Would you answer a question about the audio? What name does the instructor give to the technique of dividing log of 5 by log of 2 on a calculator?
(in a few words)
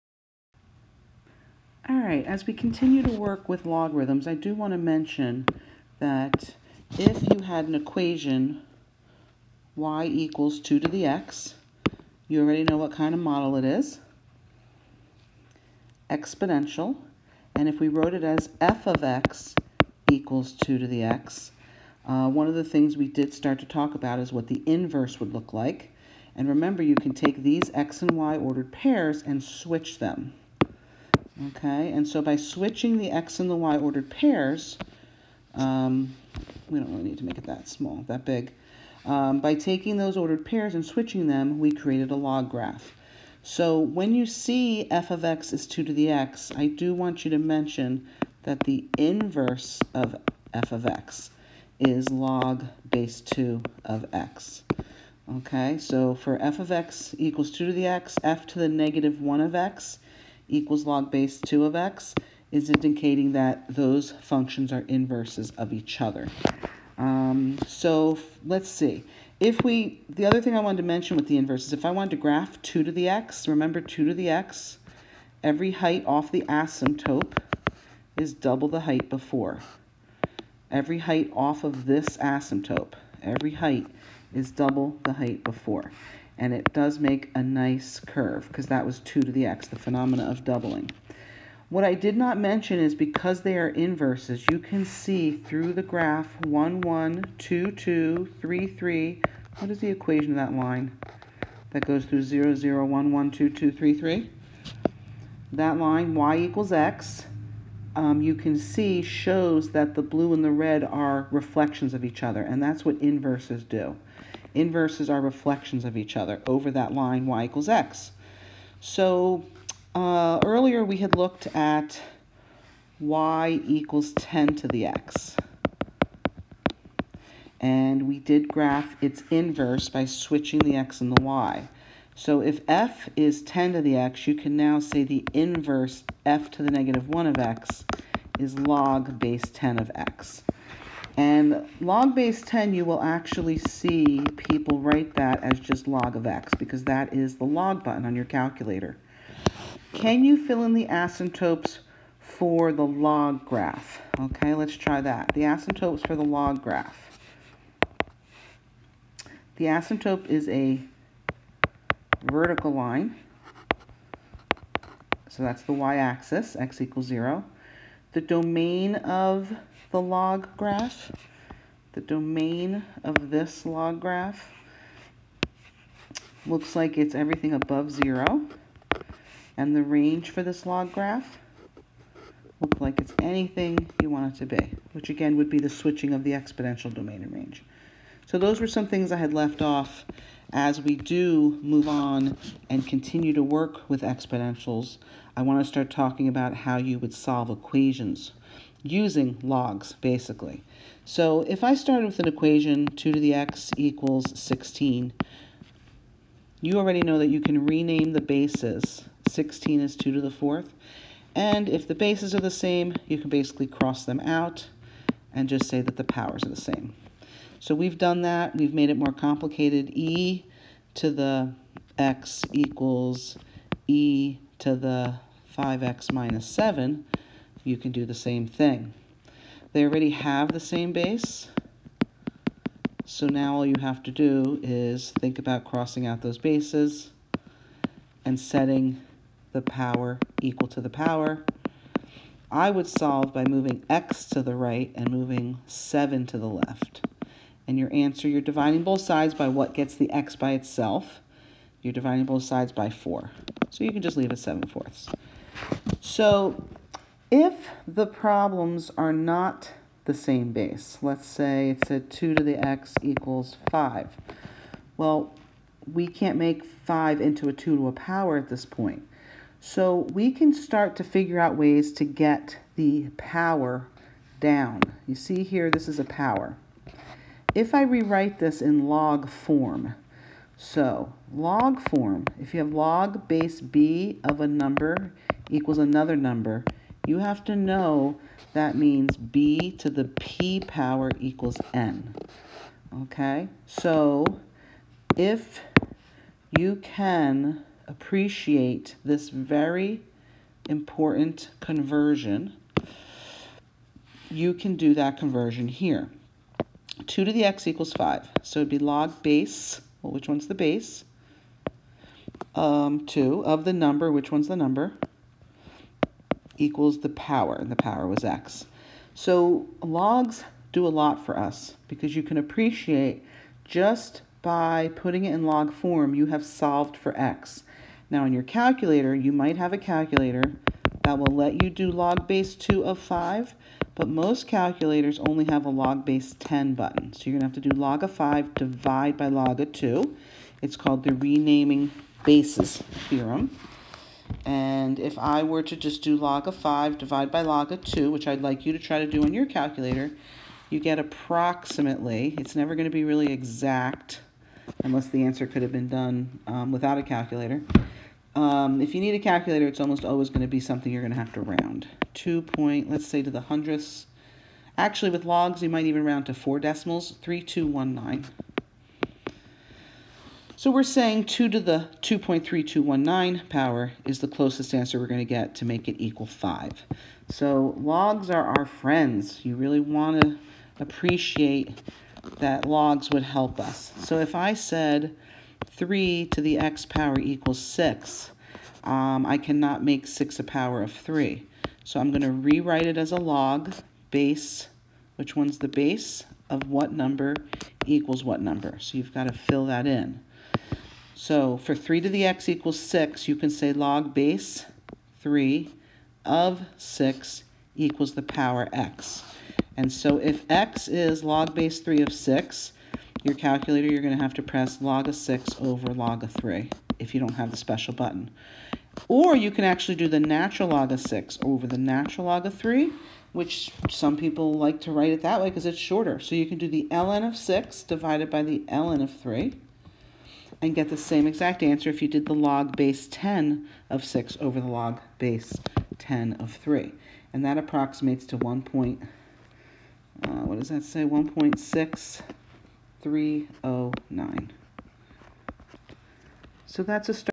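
renaming bases theorem.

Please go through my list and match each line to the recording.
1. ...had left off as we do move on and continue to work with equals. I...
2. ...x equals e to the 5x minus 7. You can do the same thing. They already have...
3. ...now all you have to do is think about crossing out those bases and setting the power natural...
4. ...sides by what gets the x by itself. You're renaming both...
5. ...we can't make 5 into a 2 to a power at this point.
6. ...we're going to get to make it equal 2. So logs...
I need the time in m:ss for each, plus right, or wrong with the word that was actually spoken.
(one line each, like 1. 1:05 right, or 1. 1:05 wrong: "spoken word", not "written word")
1. 3:09 wrong: "exponentials", not "equals"
2. 3:41 right
3. 3:53 wrong: "equal", not "natural"
4. 4:08 wrong: "dividing", not "renaming"
5. 4:25 right
6. 6:14 wrong: "5", not "2".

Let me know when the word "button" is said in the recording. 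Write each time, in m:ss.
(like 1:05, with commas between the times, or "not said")
2:27, 5:36, 6:57.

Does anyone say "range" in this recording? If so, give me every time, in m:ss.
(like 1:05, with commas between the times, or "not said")
2:59, 3:07.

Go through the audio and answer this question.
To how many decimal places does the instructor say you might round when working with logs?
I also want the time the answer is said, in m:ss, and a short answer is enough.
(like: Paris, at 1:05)
4, at 6:06.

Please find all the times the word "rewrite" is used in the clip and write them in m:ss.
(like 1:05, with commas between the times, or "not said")
4:37, 6:32.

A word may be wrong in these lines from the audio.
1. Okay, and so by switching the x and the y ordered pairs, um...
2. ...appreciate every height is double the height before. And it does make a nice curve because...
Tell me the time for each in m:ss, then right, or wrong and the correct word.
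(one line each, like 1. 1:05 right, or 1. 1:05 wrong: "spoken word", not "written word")
1. 0:31 right
2. 1:22 wrong: "asymptote", not "appreciate".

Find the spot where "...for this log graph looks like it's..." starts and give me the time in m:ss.
3:00.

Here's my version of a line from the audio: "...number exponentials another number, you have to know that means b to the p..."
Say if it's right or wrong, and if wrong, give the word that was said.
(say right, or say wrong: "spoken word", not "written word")
wrong: "equals", not "exponentials".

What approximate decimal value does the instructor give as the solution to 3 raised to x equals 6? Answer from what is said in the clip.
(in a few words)
1.6309.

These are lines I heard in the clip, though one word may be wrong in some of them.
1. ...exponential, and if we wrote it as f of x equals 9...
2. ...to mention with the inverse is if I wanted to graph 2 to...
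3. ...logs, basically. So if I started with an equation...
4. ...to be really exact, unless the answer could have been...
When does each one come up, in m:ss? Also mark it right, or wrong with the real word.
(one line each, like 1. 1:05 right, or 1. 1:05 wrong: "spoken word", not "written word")
1. 0:16 wrong: "2", not "9"
2. 1:10 right
3. 3:19 right
4. 5:52 right.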